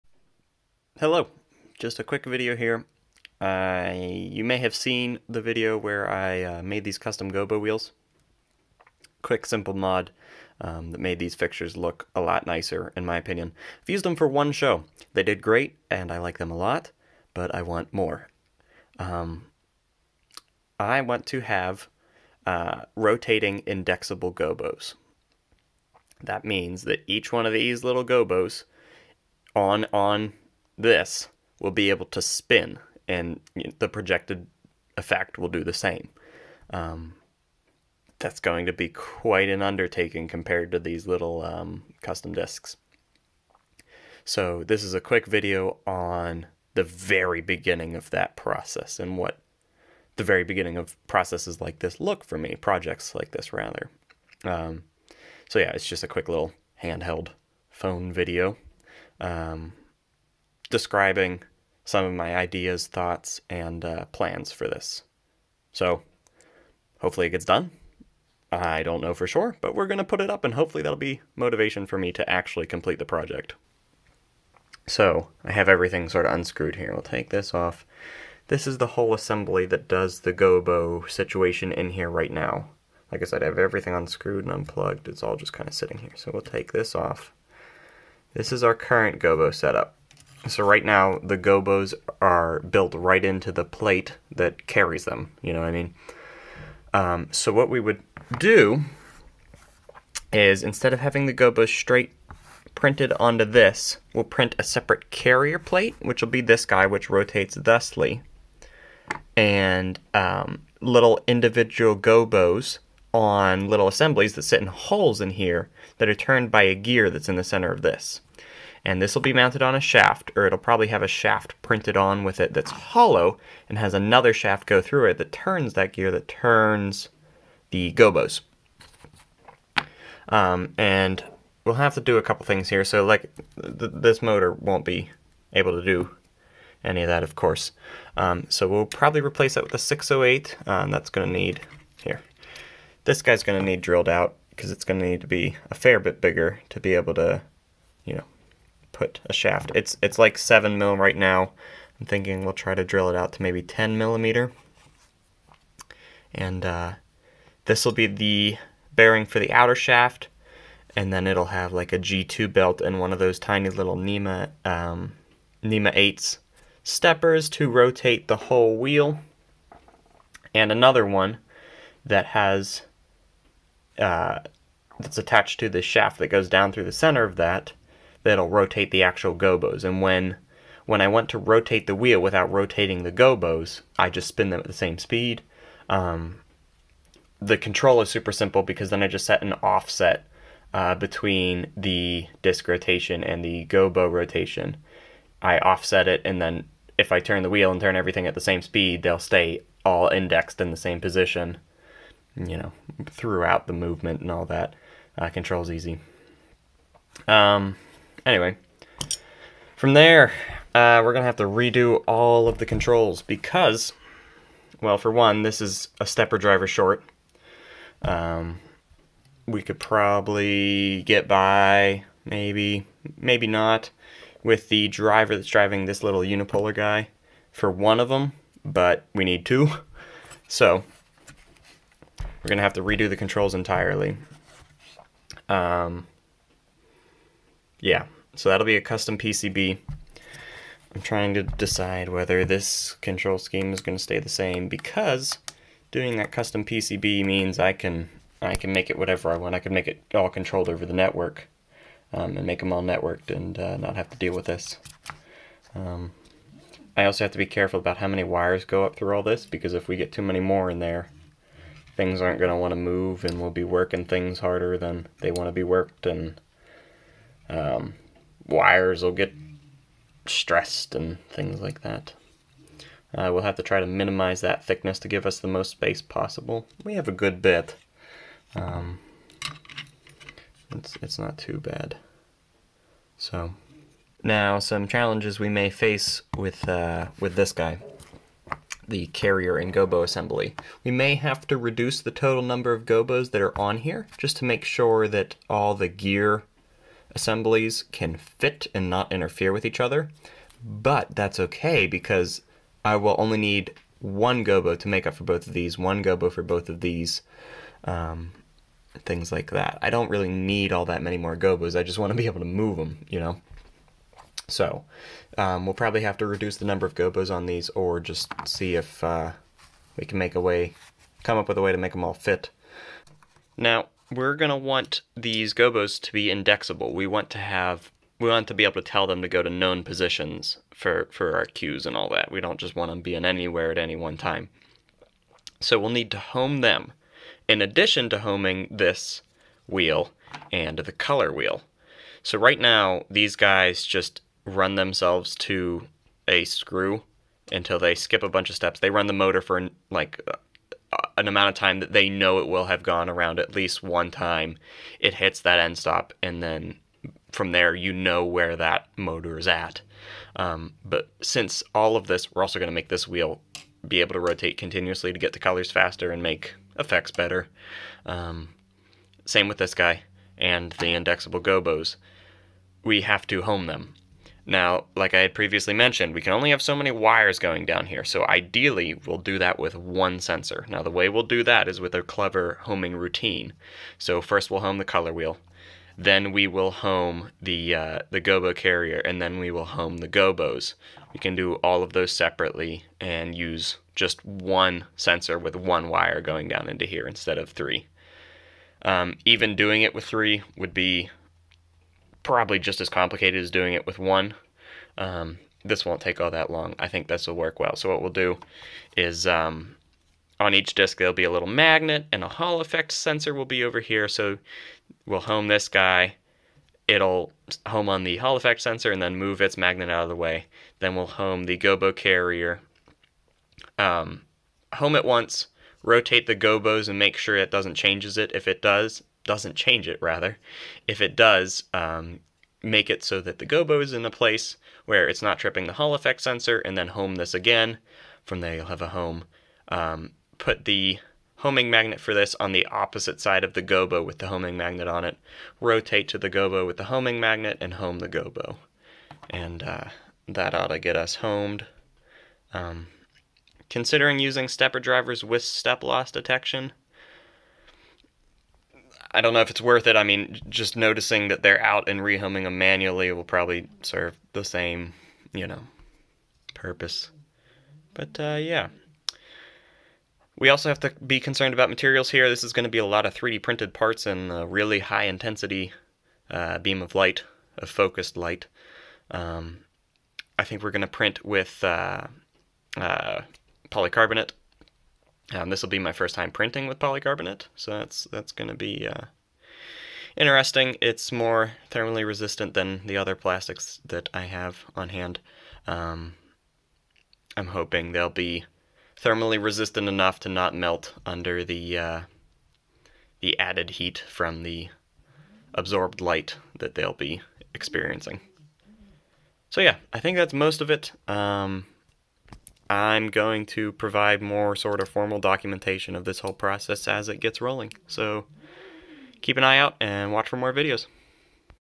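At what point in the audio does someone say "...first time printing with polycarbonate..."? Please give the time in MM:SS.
08:05.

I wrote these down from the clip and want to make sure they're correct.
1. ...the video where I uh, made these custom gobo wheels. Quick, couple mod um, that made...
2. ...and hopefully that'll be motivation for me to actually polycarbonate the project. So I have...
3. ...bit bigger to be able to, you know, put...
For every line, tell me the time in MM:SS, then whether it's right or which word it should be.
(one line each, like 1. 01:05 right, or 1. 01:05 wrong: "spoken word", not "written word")
1. 00:05 wrong: "simple", not "couple"
2. 01:10 wrong: "complete", not "polycarbonate"
3. 02:25 right.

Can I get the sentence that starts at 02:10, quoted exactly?
Um, and we'll have to do a couple things here.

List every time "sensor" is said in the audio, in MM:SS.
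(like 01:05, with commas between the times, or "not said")
06:20, 06:34, 06:52, 06:58, 07:16.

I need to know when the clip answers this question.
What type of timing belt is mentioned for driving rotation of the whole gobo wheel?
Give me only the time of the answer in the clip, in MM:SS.
02:41.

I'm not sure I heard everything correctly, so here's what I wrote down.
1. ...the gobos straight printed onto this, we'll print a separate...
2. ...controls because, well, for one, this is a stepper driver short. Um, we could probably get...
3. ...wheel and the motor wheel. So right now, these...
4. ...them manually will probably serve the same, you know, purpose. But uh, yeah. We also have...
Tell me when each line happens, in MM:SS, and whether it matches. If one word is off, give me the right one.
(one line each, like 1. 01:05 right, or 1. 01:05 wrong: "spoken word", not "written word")
1. 01:41 right
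2. 03:32 right
3. 05:39 wrong: "color", not "motor"
4. 07:42 right.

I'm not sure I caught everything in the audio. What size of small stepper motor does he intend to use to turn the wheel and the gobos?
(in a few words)
NEMA 8.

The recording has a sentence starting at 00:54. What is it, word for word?
Um, so yeah, it's just a quick little handheld phone video.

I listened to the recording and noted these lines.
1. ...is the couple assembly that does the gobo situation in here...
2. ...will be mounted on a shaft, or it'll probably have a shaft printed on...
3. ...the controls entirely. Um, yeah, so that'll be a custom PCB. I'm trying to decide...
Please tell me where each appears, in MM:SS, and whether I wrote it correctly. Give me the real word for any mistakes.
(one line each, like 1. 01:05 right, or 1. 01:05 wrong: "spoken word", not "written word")
1. 01:18 wrong: "whole", not "couple"
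2. 01:59 right
3. 03:53 right.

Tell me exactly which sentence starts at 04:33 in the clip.
Uh, we'll have to try to minimize that thickness to give us the most space possible.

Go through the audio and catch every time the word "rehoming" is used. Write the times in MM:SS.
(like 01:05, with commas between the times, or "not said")
07:41.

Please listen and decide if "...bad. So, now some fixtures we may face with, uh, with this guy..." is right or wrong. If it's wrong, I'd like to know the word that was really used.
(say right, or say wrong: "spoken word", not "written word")
wrong: "challenges", not "fixtures".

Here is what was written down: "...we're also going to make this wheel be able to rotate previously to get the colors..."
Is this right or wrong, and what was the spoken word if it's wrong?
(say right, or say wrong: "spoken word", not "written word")
wrong: "continuously", not "previously".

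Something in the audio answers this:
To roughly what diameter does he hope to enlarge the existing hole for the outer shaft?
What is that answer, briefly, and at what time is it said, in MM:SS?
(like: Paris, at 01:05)
10 millimeters, at 02:33.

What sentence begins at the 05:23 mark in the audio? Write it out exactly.
Now, we're going to want these gobos to be indexable.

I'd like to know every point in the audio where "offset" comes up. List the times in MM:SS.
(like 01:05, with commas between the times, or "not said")
03:09, 03:15.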